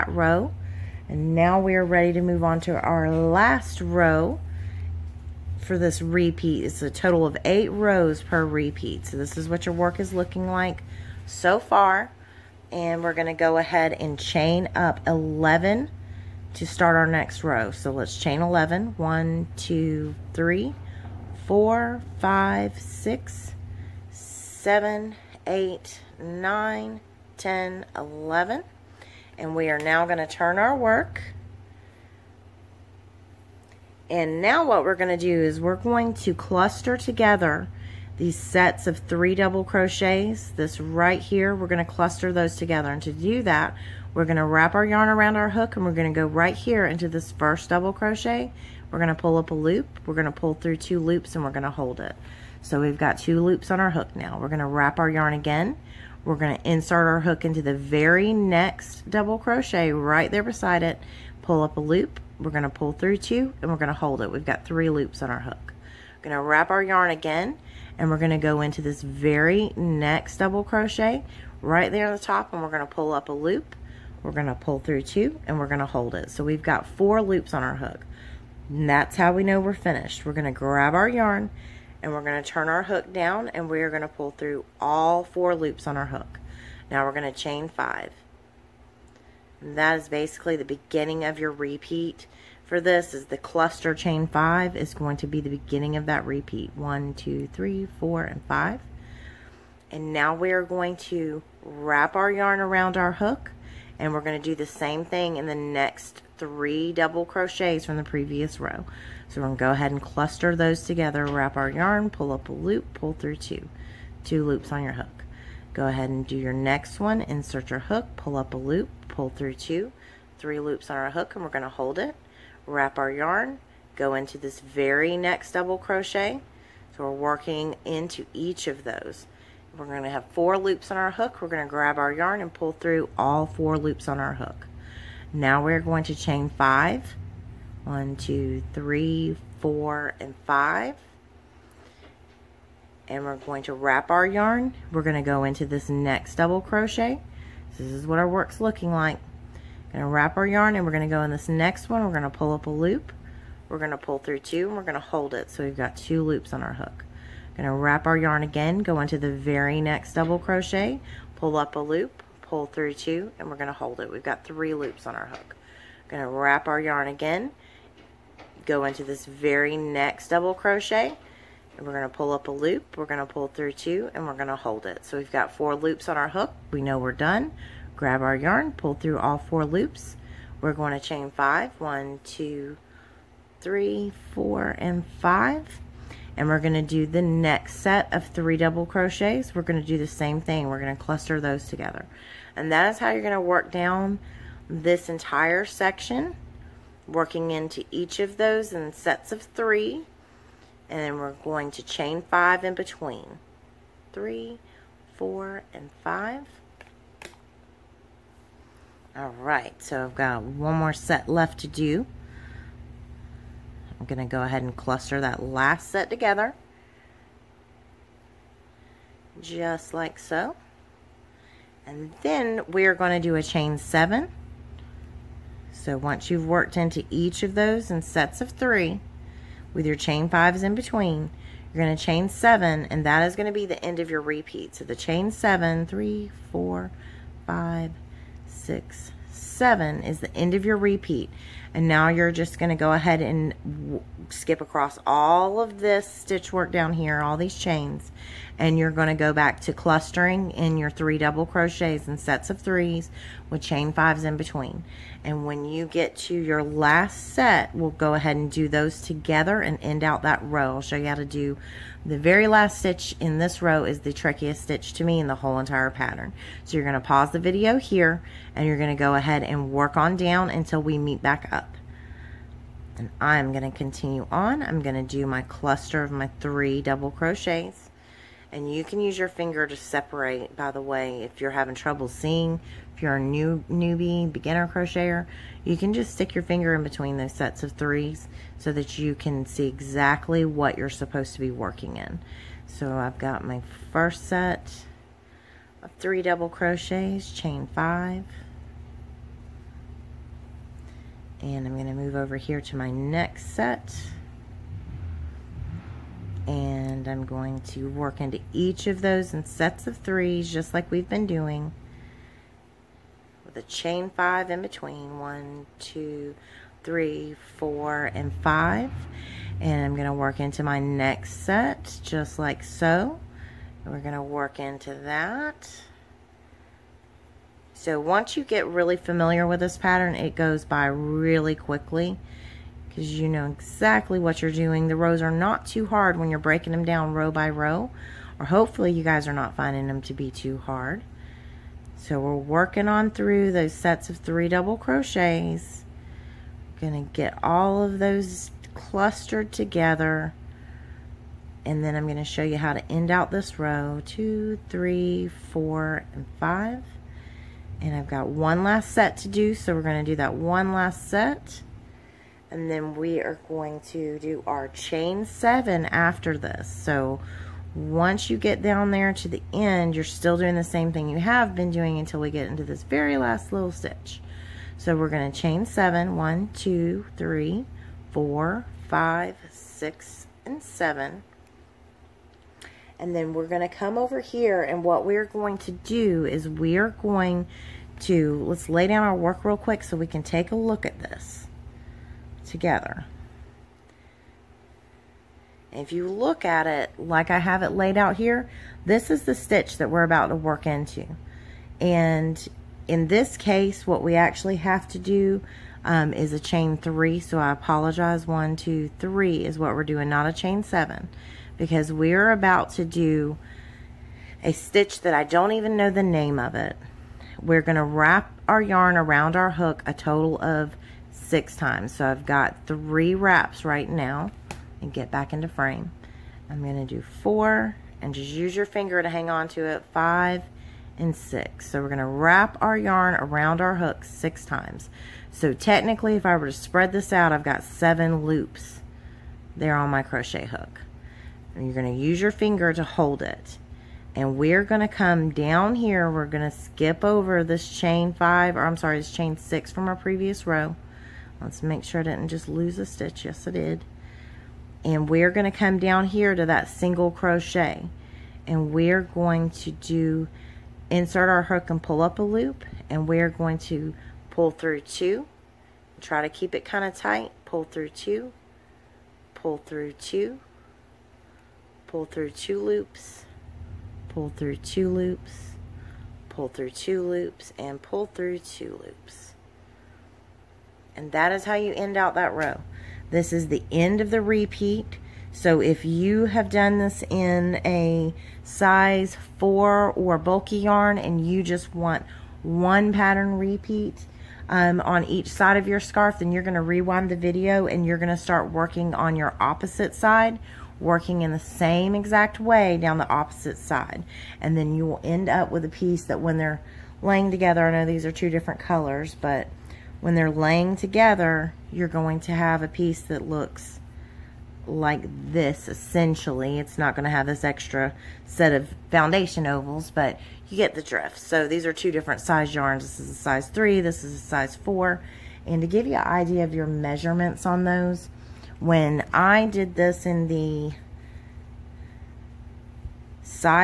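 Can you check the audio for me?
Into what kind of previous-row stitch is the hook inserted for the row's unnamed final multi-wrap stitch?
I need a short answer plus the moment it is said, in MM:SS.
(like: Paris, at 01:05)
single crochet, at 07:36.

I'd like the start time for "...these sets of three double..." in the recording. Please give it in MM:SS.
00:38.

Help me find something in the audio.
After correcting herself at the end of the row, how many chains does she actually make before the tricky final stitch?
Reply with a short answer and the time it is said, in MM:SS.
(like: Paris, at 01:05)
3, at 06:46.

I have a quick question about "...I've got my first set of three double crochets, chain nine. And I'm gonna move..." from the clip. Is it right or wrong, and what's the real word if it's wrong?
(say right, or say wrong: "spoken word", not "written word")
wrong: "five", not "nine".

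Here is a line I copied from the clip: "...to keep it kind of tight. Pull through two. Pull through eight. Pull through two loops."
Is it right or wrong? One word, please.
wrong.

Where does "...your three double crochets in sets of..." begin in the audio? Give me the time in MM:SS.
04:10.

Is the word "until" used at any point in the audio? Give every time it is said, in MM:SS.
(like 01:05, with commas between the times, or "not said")
04:30, 06:11.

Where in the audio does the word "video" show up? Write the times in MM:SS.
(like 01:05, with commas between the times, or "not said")
04:27, 08:17.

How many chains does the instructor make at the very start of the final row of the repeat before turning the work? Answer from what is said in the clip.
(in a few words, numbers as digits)
11.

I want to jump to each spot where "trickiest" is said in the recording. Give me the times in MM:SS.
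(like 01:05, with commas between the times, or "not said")
04:24.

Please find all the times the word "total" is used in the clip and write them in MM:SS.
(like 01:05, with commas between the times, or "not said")
00:06, 06:59.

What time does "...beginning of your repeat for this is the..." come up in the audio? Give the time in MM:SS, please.
01:30.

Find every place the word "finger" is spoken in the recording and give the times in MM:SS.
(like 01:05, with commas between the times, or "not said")
04:39, 04:46, 07:08, 07:22.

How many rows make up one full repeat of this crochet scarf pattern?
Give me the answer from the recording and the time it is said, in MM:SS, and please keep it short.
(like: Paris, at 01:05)
8, at 00:07.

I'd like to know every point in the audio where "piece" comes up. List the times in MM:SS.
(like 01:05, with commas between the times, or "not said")
08:25, 08:32.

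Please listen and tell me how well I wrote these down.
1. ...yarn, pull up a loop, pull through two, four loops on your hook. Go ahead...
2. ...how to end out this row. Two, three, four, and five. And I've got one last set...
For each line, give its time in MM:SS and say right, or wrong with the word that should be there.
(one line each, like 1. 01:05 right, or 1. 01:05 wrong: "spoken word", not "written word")
1. 01:51 wrong: "two", not "four"
2. 05:52 right.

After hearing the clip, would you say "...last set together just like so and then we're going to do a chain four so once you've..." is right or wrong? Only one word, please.
wrong.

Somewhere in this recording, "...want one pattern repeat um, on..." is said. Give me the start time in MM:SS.
08:11.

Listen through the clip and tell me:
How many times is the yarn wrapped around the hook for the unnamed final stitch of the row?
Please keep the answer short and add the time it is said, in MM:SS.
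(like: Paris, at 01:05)
6, at 06:59.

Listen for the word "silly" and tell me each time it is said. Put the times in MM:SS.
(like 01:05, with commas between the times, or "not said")
not said.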